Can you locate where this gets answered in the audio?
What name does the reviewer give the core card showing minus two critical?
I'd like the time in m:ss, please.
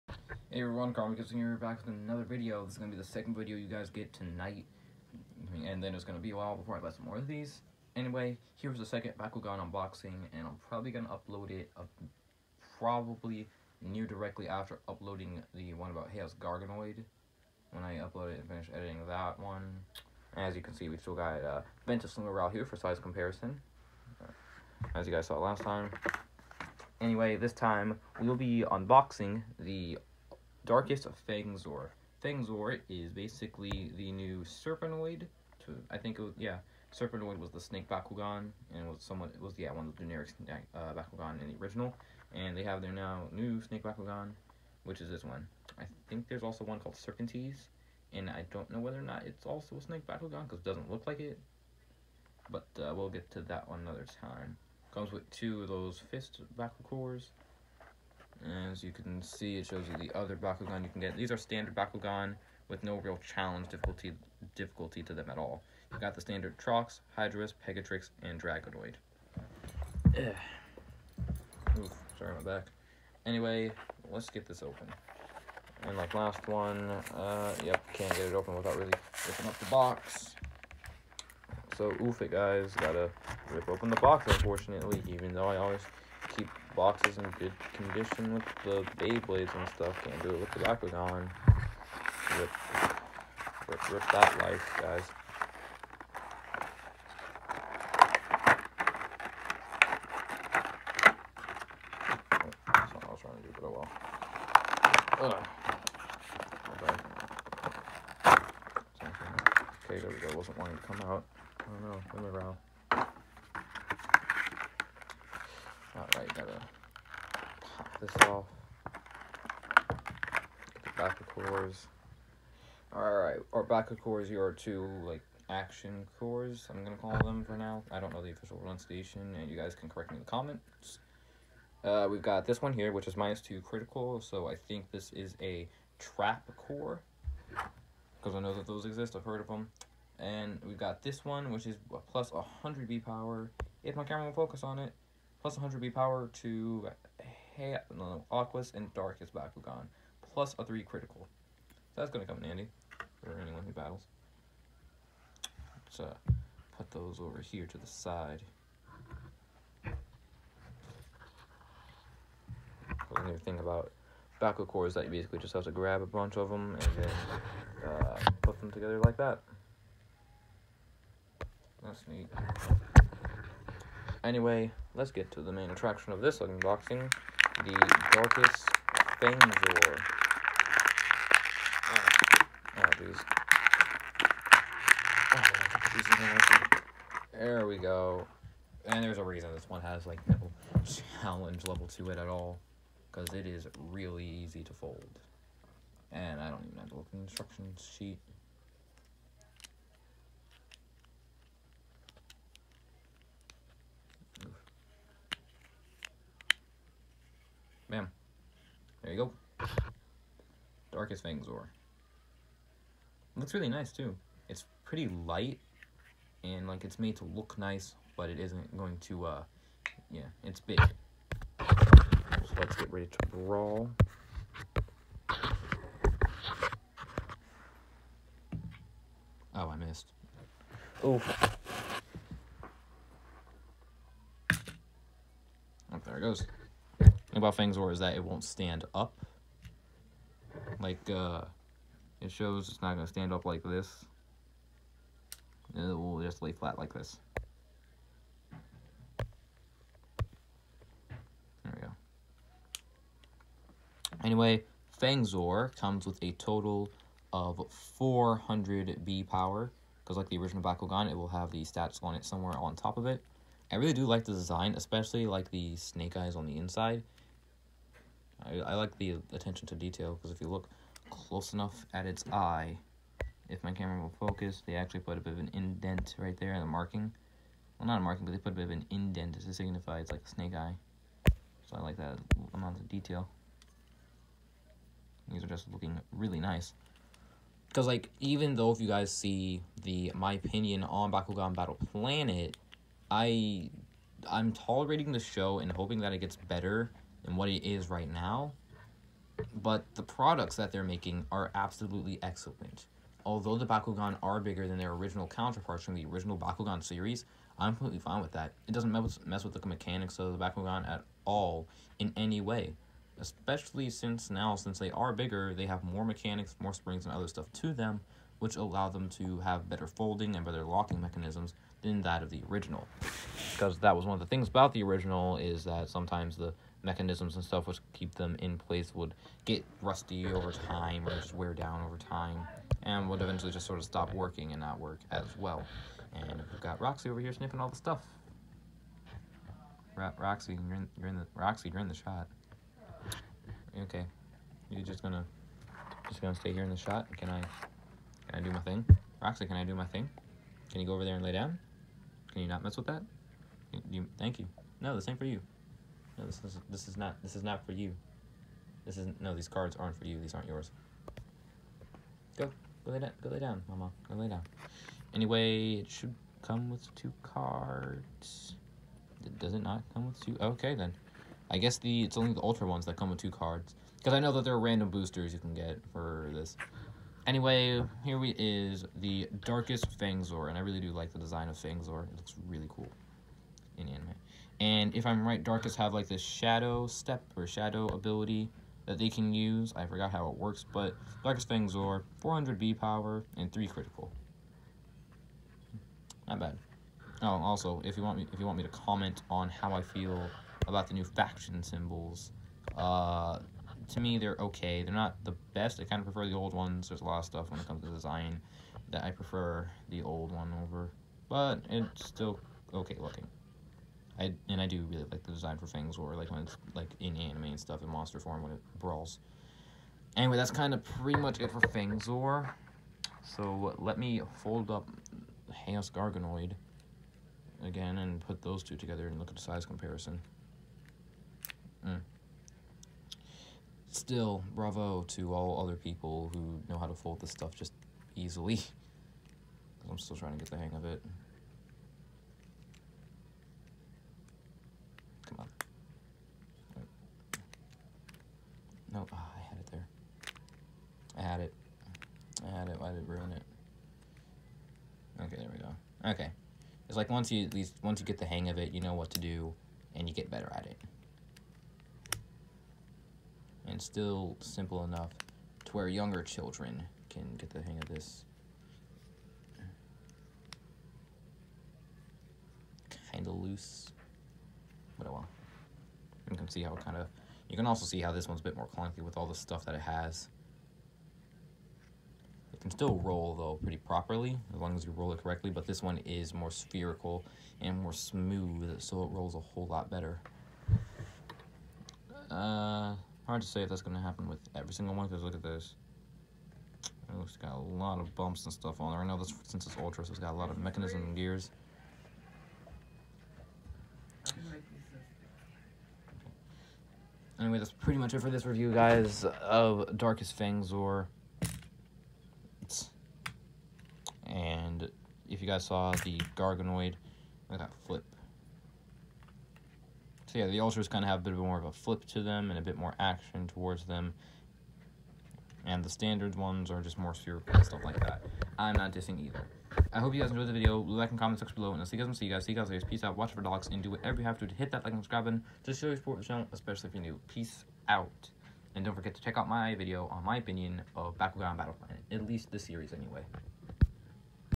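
2:15.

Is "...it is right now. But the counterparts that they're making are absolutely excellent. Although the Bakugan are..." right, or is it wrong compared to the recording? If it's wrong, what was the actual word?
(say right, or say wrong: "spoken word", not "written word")
wrong: "products", not "counterparts".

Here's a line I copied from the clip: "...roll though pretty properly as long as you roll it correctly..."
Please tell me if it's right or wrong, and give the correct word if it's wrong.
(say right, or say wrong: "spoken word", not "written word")
right.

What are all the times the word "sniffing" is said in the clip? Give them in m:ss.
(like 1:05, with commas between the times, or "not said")
5:37.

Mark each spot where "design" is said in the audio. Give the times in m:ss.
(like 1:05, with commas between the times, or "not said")
4:24, 6:21, 6:47, 6:55.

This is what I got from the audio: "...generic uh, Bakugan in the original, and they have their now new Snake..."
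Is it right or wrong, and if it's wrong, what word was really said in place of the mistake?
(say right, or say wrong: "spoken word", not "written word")
right.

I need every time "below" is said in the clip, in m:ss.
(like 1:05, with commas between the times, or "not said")
8:51.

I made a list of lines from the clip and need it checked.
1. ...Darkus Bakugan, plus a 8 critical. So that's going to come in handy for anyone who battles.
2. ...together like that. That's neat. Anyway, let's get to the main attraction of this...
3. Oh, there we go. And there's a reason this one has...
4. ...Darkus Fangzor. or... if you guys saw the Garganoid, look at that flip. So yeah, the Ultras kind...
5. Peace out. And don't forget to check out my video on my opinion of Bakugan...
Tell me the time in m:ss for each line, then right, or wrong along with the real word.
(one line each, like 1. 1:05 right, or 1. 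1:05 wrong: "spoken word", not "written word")
1. 2:28 wrong: "3", not "8"
2. 2:48 right
3. 3:07 right
4. 8:29 right
5. 8:57 right.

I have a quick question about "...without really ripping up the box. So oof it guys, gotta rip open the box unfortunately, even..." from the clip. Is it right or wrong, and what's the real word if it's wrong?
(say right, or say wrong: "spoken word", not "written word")
right.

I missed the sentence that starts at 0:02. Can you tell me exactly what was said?
This is going to be the second video you guys get tonight.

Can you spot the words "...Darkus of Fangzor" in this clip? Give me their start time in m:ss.
0:30.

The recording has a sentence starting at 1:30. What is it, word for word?
Can't do it with the Bakugan.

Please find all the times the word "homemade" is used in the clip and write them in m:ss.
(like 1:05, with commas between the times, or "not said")
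not said.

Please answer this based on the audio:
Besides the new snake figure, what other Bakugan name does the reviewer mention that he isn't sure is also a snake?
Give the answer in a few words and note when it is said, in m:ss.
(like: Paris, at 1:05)
Serpenteze, at 0:46.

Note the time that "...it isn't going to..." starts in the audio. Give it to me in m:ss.
3:38.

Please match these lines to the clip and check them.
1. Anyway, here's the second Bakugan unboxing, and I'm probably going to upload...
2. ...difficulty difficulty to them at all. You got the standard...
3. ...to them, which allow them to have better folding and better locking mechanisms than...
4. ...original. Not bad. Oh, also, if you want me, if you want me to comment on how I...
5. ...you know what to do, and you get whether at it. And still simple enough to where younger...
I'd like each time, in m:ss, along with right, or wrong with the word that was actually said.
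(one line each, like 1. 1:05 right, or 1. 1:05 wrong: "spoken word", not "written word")
1. 0:07 right
2. 1:03 right
3. 5:17 right
4. 6:33 wrong: "critical", not "original"
5. 7:38 wrong: "better", not "whether".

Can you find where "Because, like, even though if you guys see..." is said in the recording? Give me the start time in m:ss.
4:47.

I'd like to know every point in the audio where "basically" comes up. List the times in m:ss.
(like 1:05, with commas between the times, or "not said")
0:33, 2:45.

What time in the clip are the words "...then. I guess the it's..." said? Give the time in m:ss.
6:10.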